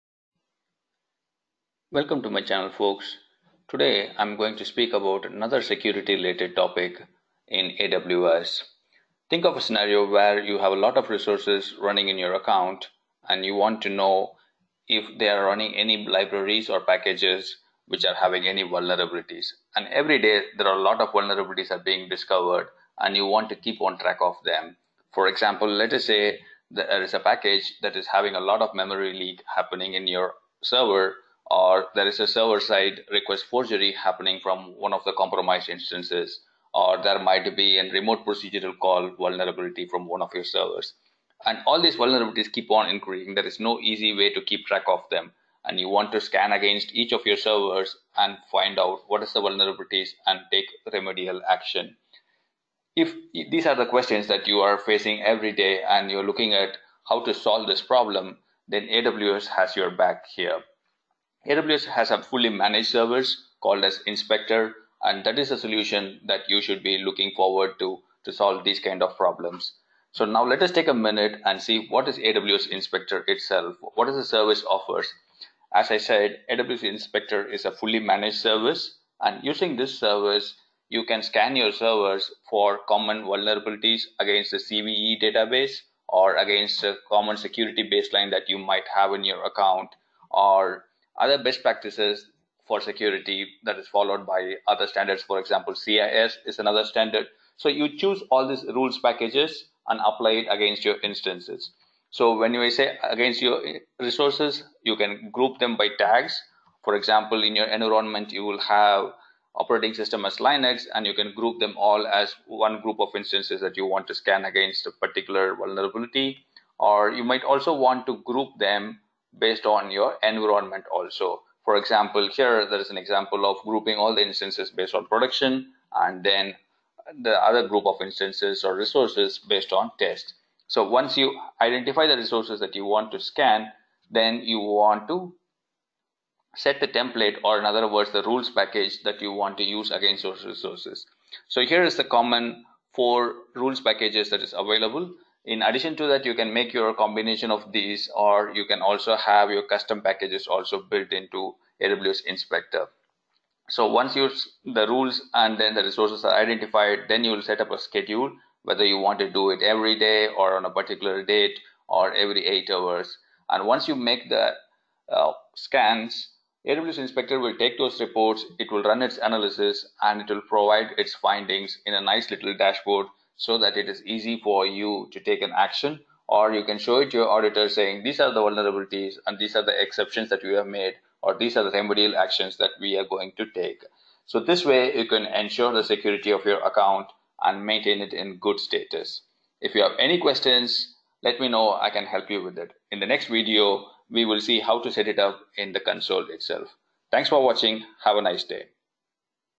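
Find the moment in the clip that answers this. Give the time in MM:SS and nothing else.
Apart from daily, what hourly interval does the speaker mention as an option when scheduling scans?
02:42.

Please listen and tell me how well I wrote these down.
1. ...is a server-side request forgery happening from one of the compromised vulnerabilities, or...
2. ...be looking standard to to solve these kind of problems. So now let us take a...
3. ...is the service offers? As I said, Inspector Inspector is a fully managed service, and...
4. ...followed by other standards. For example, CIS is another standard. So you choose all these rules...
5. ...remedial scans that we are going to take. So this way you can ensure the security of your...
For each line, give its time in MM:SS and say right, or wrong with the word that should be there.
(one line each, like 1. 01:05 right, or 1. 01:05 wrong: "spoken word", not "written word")
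1. 00:32 wrong: "instances", not "vulnerabilities"
2. 01:06 wrong: "forward", not "standard"
3. 01:14 wrong: "AWS", not "Inspector"
4. 01:33 right
5. 03:01 wrong: "actions", not "scans".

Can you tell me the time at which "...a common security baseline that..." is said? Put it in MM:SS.
01:26.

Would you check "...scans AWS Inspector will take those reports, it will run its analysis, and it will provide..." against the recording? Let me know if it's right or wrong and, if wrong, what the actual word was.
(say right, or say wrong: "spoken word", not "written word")
right.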